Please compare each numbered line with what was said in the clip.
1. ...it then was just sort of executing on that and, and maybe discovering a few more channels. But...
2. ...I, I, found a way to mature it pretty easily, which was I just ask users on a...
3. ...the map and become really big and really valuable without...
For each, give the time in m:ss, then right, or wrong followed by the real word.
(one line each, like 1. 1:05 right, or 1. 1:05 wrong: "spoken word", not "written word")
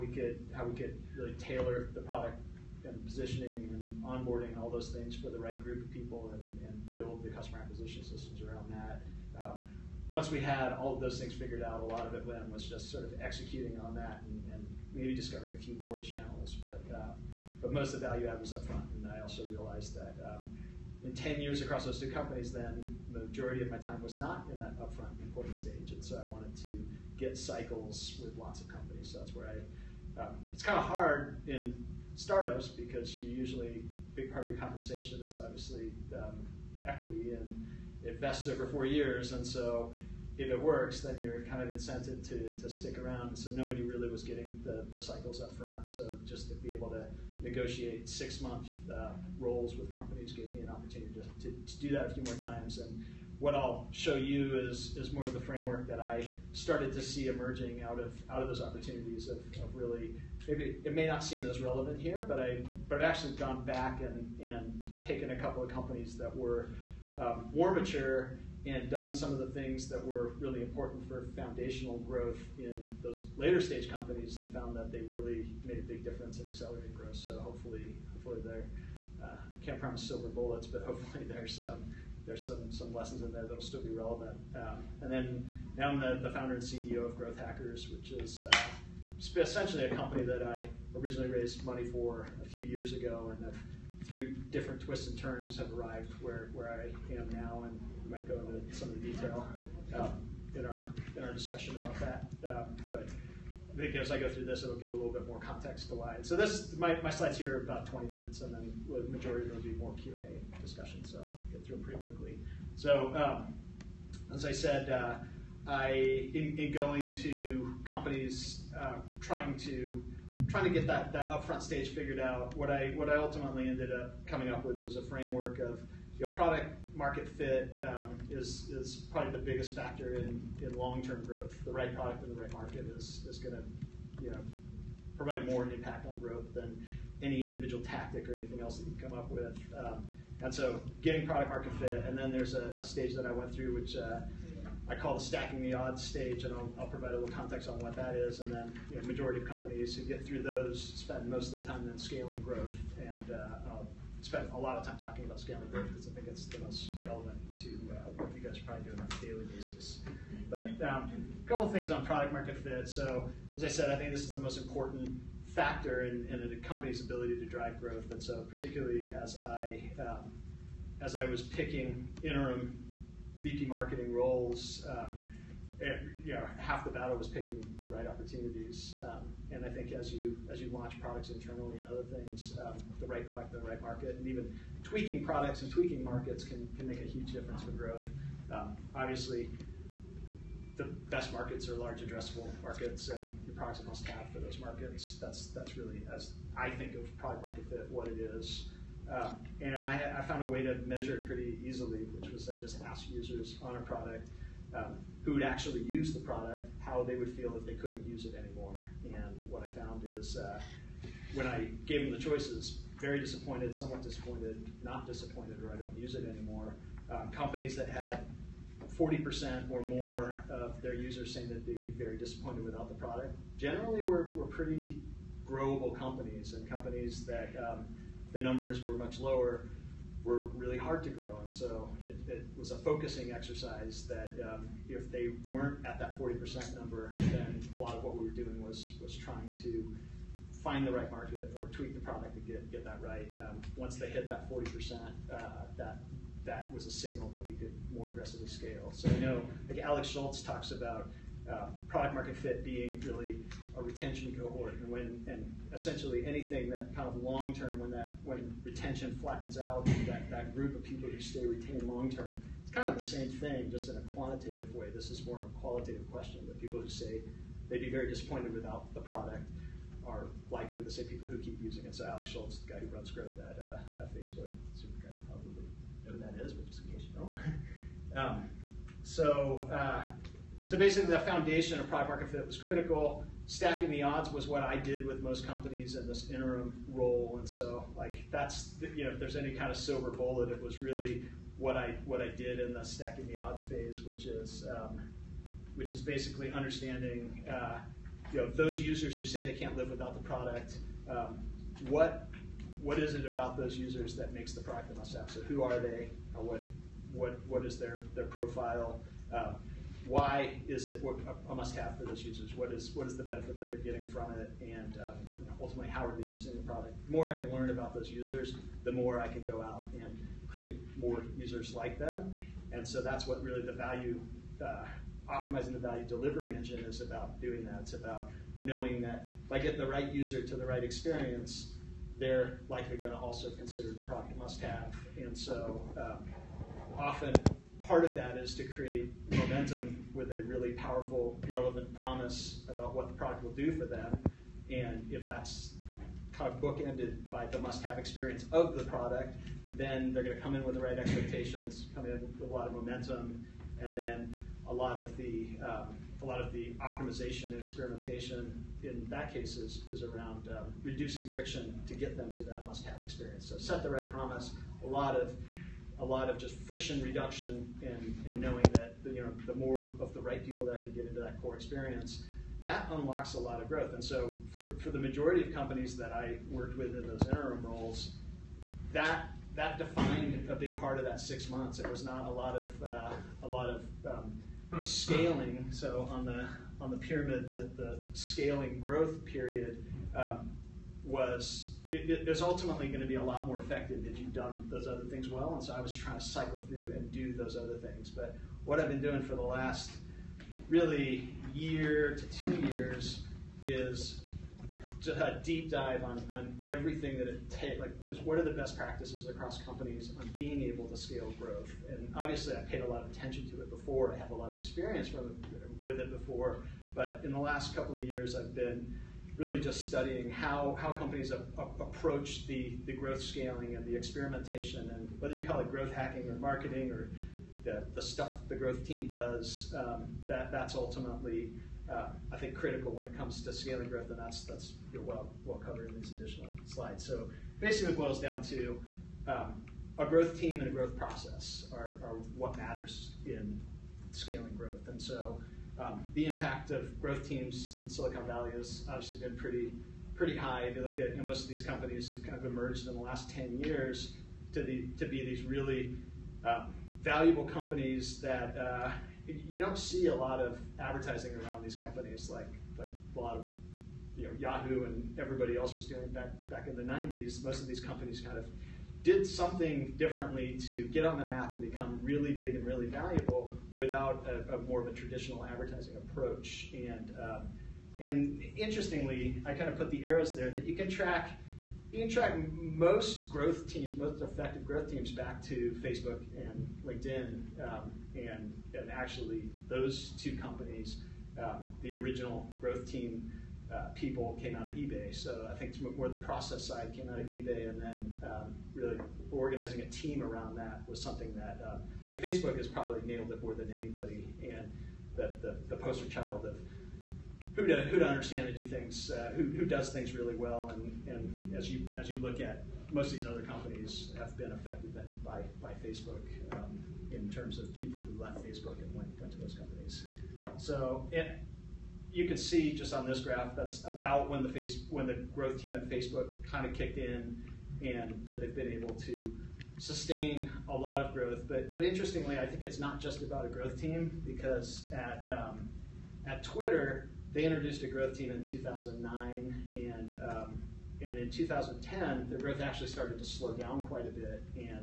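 1. 0:12 right
2. 3:19 wrong: "measure", not "mature"
3. 7:51 right.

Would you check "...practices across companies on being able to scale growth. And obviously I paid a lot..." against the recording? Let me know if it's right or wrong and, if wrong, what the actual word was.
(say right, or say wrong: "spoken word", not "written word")
right.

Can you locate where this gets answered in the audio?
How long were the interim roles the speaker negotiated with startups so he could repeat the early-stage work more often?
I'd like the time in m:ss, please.
0:48.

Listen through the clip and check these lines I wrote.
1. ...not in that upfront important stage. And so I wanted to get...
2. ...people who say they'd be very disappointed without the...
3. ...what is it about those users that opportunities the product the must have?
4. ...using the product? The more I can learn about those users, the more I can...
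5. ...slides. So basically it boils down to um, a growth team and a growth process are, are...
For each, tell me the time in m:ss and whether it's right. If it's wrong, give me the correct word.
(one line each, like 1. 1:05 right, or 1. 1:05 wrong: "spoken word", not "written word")
1. 0:24 right
2. 4:26 right
3. 5:02 wrong: "makes", not "opportunities"
4. 5:16 right
5. 7:16 right.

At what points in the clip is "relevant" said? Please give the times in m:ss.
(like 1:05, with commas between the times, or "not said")
1:01, 1:23, 2:37, 5:41.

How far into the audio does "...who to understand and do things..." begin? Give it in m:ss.
8:27.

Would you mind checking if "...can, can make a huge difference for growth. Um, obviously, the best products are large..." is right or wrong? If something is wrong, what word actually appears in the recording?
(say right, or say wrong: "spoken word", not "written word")
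wrong: "markets", not "products".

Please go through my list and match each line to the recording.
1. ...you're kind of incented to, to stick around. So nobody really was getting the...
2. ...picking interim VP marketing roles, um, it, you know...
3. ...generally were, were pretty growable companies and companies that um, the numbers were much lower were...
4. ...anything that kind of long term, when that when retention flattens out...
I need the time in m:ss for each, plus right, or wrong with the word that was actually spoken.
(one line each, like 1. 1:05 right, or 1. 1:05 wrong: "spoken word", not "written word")
1. 0:41 right
2. 2:51 right
3. 3:43 right
4. 4:16 right.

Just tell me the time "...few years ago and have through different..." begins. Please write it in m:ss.
1:32.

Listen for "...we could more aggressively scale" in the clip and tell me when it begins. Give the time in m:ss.
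4:07.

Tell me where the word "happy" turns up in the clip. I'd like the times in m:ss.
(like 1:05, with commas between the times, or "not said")
not said.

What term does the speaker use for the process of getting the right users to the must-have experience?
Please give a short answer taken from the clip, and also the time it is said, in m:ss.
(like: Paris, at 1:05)
value delivery engine, at 5:25.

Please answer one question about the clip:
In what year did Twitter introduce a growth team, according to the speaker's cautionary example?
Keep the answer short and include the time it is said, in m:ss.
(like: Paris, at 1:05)
2009, at 8:58.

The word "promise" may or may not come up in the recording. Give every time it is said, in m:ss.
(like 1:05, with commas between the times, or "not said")
1:19, 5:41, 6:04.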